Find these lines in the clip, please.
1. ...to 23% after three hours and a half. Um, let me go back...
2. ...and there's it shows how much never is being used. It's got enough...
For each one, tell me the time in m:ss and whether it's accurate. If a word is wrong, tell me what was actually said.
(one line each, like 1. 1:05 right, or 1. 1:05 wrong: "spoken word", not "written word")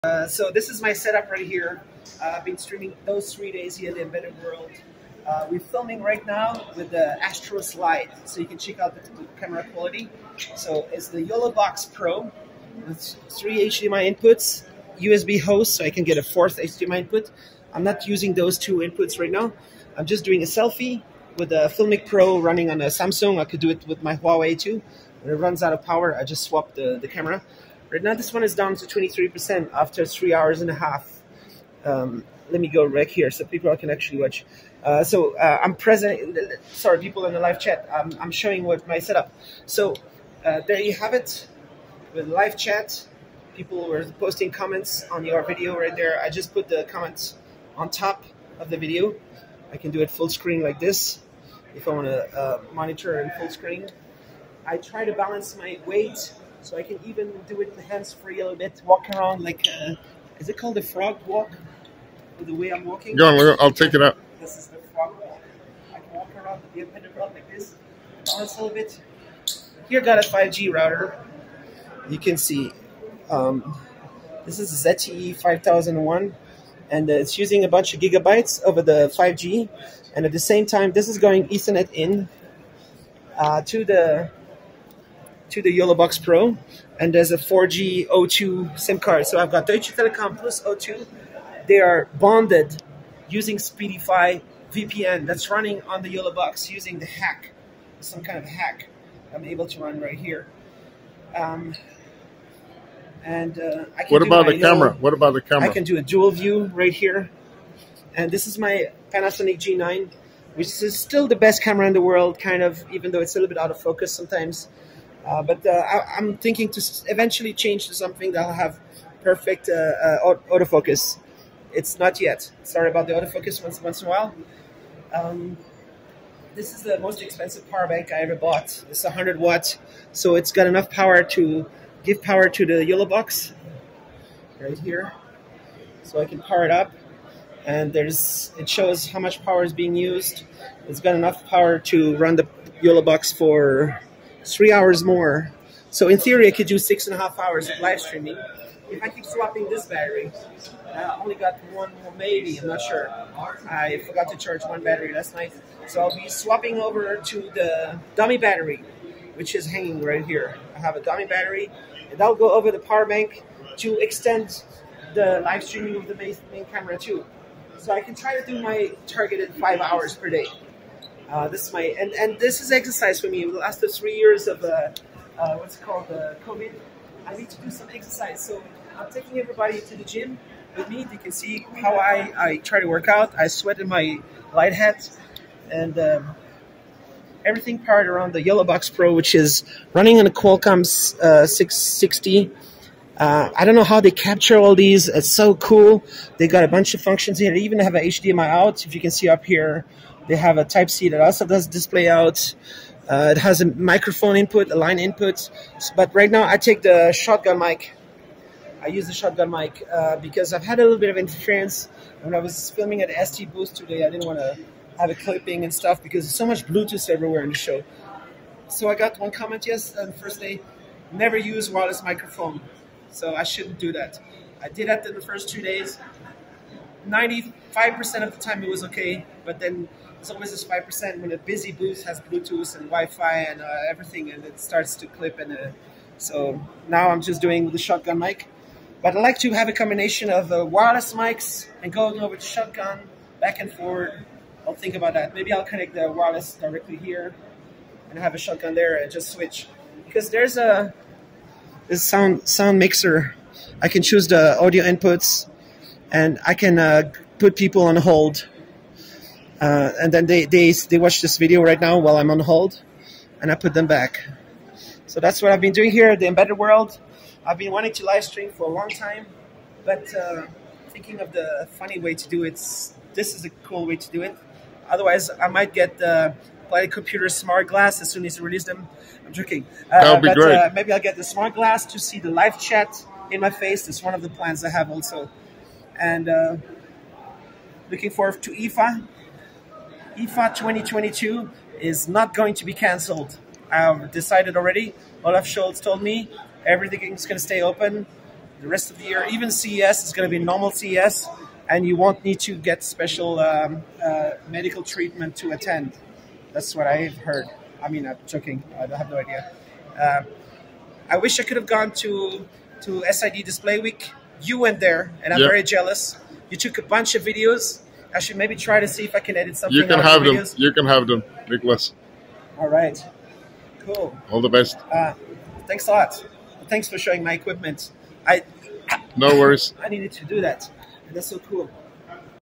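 1. 0:28 right
2. 2:17 wrong: "power", not "never".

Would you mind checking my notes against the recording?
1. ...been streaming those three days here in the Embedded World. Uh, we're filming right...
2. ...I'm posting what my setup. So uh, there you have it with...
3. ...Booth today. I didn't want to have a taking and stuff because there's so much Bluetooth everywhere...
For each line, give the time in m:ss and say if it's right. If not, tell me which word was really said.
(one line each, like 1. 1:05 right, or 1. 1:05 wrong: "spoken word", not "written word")
1. 0:02 right
2. 0:38 wrong: "showing", not "posting"
3. 3:33 wrong: "clipping", not "taking".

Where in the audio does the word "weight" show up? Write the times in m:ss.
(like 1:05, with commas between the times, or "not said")
0:55.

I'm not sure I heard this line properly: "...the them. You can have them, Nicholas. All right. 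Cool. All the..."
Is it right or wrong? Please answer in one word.
right.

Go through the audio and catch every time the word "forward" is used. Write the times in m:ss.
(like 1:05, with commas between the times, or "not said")
4:03, 4:48.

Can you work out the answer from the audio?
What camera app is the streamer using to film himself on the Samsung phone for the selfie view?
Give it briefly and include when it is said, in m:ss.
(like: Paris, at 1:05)
Filmic Pro, at 0:21.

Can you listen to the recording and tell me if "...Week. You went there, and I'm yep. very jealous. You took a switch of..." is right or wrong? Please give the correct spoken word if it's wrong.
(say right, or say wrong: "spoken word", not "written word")
wrong: "bunch", not "switch".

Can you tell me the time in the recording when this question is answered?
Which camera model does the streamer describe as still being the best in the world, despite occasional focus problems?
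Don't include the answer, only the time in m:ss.
1:49.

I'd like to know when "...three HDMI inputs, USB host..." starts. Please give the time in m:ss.
0:13.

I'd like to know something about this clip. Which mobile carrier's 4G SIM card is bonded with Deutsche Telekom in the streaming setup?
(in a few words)
O2.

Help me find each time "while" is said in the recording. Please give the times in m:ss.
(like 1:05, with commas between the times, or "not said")
2:04, 4:21.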